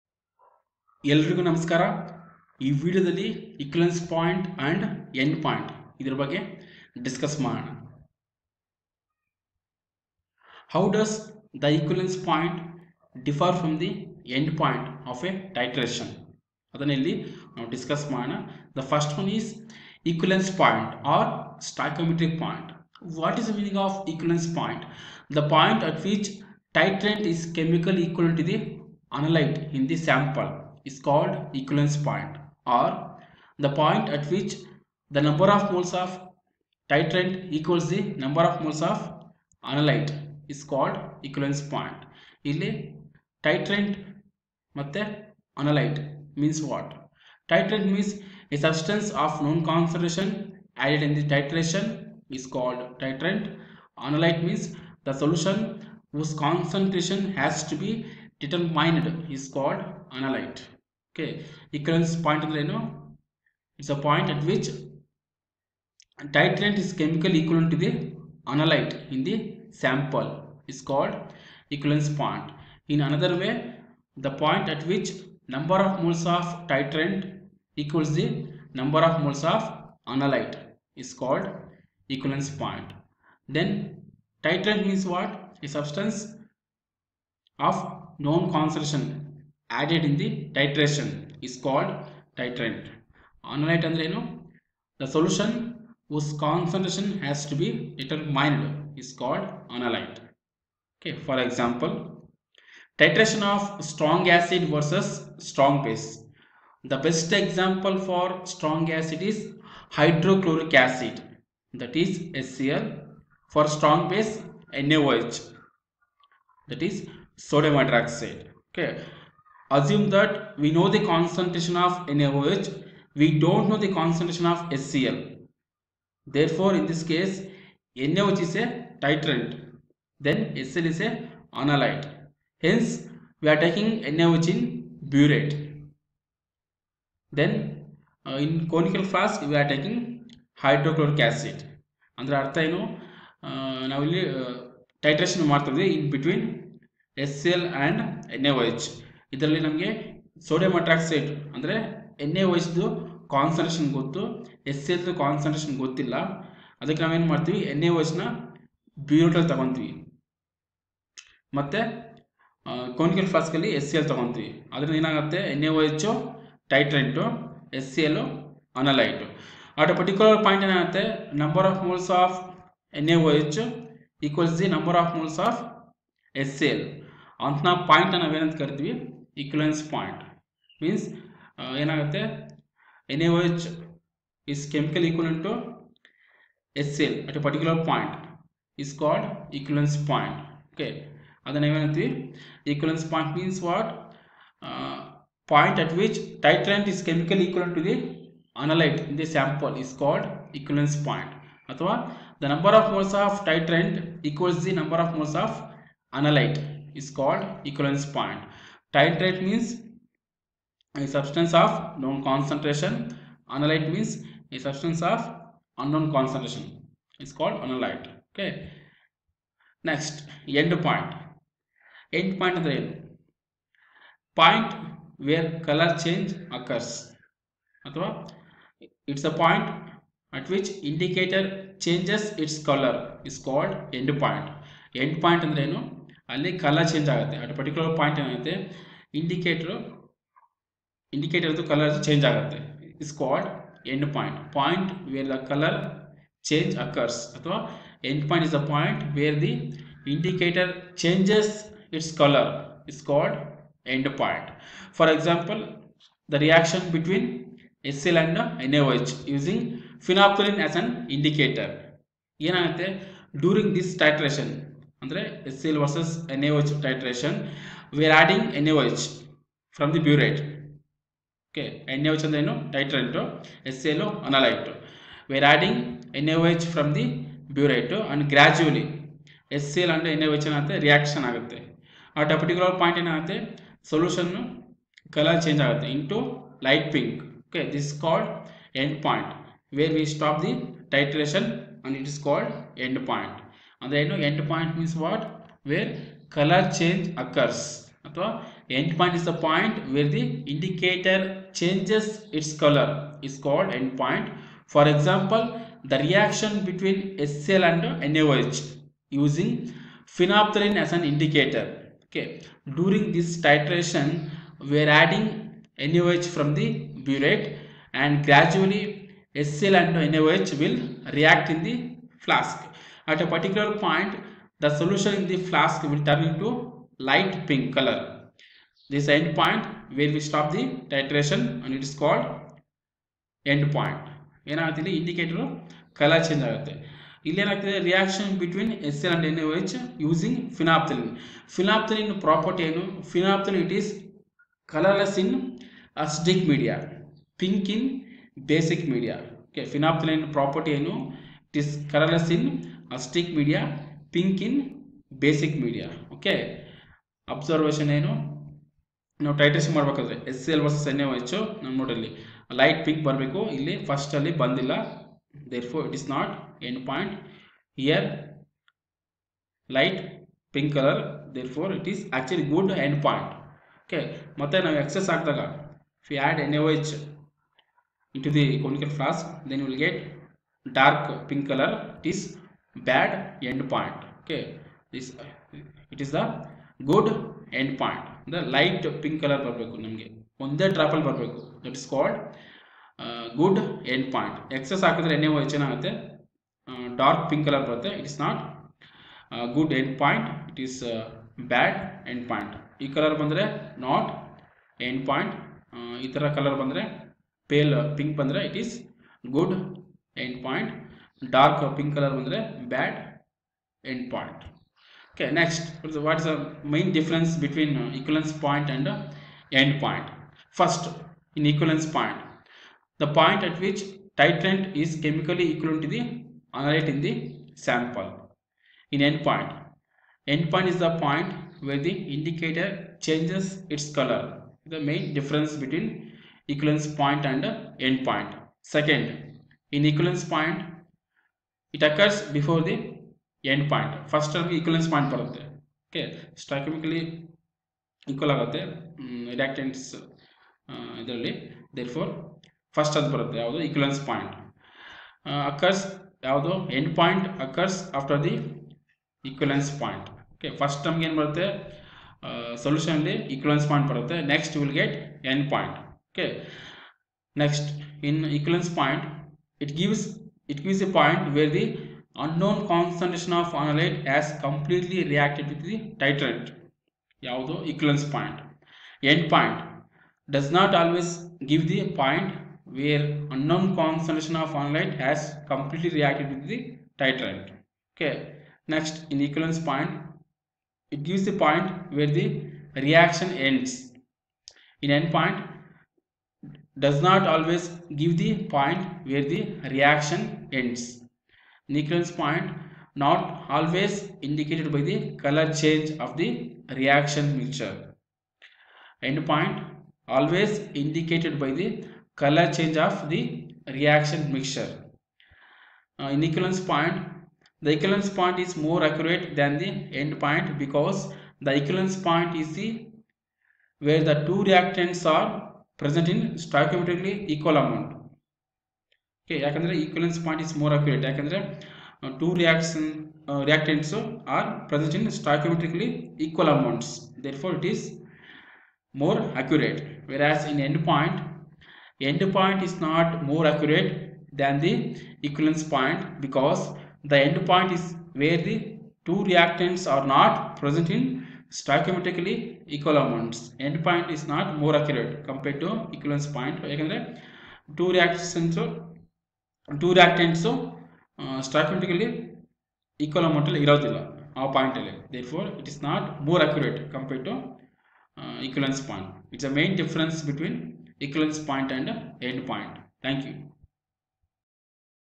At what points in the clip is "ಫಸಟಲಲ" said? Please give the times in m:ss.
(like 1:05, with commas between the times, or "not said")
6:03.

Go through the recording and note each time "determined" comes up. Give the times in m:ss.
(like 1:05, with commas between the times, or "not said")
0:58, 1:37.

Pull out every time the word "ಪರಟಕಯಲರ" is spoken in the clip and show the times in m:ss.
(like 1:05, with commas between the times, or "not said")
2:49, 4:42.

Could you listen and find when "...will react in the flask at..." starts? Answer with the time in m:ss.
5:20.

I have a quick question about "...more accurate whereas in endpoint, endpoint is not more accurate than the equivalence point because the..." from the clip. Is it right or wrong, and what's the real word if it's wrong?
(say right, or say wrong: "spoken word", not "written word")
right.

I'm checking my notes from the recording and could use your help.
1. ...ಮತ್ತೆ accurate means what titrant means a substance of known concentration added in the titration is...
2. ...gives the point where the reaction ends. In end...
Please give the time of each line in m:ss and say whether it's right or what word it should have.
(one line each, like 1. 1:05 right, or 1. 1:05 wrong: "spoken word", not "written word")
1. 0:44 wrong: "analyte", not "accurate"
2. 8:11 right.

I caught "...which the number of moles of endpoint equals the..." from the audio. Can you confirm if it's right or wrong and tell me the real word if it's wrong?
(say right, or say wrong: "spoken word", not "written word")
wrong: "titrant", not "endpoint".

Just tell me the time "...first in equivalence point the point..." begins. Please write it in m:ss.
7:00.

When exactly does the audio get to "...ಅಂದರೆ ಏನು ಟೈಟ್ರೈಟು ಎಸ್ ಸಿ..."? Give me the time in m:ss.
4:32.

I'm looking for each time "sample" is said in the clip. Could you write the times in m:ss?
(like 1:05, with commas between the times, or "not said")
1:09, 3:19, 7:07.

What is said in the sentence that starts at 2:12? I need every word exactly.
Hence, we are taking NaOH in burette.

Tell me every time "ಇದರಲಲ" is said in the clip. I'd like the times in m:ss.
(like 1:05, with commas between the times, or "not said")
2:29, 7:31.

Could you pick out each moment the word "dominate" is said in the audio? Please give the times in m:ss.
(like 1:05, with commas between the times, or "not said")
not said.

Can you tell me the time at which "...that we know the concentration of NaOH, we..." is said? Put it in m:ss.
2:00.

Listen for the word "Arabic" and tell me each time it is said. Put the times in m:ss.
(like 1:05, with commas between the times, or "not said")
not said.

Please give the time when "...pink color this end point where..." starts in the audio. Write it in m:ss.
5:27.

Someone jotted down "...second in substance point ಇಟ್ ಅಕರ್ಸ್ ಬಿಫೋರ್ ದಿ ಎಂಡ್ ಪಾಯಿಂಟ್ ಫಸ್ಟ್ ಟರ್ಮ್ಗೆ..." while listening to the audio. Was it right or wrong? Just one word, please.
wrong.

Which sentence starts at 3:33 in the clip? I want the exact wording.
Analyte means a substance of unknown concentration.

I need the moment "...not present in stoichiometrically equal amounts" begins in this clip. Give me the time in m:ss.
9:10.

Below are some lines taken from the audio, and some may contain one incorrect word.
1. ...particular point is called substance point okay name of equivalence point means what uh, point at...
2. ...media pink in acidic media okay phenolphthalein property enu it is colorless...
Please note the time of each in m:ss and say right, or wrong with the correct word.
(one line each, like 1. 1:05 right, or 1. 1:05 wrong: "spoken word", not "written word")
1. 3:07 wrong: "equivalence", not "substance"
2. 5:46 wrong: "basic", not "acidic".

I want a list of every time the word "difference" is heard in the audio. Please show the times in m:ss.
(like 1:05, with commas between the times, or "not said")
6:56, 7:15, 9:29.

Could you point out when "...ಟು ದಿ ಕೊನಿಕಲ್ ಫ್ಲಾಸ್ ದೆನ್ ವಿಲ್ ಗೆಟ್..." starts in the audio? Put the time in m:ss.
6:18.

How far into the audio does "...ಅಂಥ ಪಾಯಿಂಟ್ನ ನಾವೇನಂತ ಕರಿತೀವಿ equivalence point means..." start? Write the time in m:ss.
2:57.